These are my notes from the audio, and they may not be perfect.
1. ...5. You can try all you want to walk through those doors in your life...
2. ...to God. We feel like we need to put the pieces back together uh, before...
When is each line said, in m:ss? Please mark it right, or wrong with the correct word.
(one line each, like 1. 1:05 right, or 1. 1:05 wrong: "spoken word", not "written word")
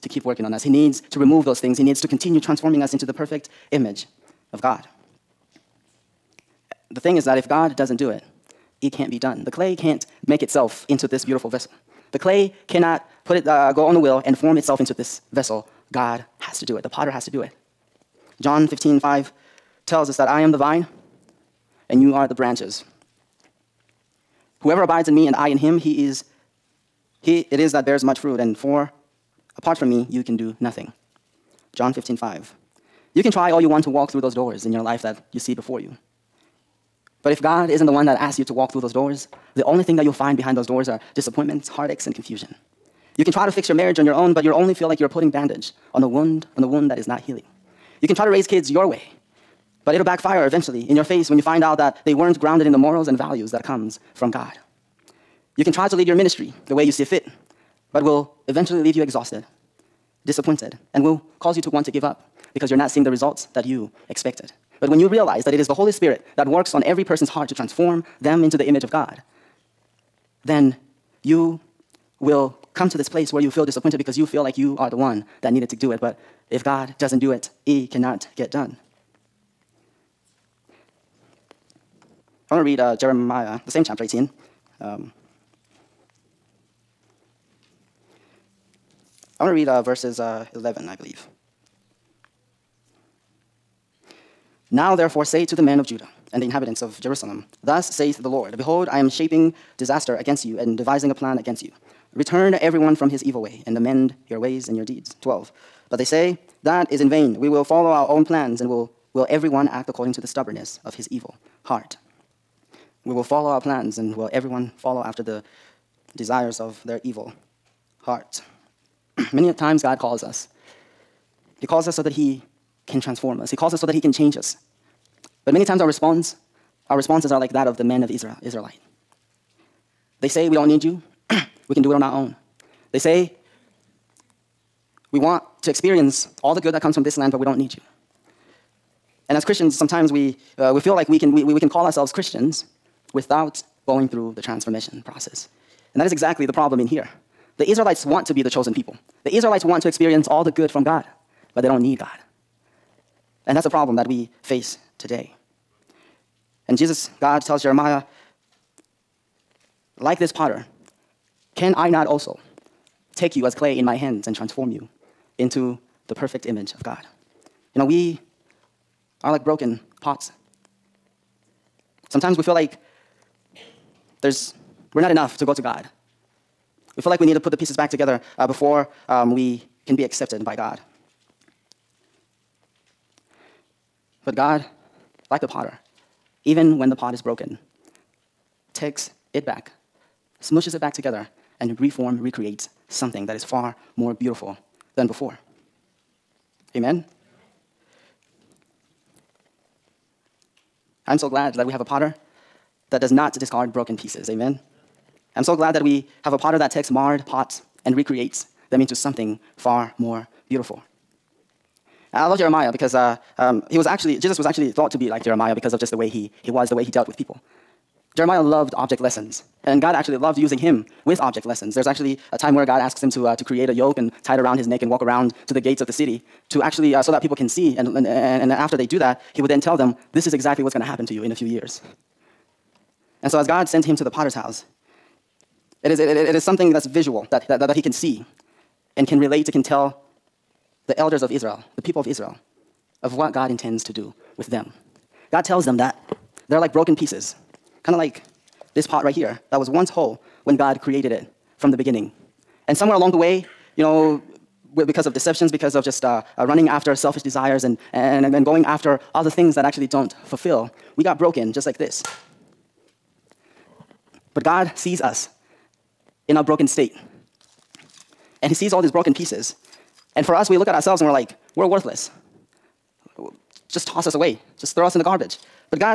1. 0:32 right
2. 2:55 right.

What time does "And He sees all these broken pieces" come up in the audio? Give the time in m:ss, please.
4:28.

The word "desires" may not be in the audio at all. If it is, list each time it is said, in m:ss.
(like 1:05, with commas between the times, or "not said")
1:56, 4:17.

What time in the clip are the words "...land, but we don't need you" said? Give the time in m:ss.
2:17.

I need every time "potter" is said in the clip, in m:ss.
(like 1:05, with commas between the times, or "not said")
0:16, 2:40, 3:05, 3:21, 3:26, 3:54.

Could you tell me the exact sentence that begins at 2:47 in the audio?
You know, we are like broken pots.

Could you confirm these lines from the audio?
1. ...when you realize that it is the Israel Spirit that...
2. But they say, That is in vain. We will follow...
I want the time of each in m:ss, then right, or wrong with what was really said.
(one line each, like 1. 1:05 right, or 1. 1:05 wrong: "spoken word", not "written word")
1. 1:04 wrong: "Holy", not "Israel"
2. 1:45 right.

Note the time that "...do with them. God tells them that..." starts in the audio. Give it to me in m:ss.
4:03.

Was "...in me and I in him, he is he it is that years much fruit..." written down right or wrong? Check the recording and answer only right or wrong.
wrong.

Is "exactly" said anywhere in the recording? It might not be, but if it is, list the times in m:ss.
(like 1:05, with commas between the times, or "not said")
2:26, 3:50.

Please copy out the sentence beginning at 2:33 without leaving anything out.
And that's a problem that we face today.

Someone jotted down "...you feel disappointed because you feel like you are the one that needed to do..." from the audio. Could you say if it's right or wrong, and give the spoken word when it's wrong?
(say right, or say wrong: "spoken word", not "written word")
right.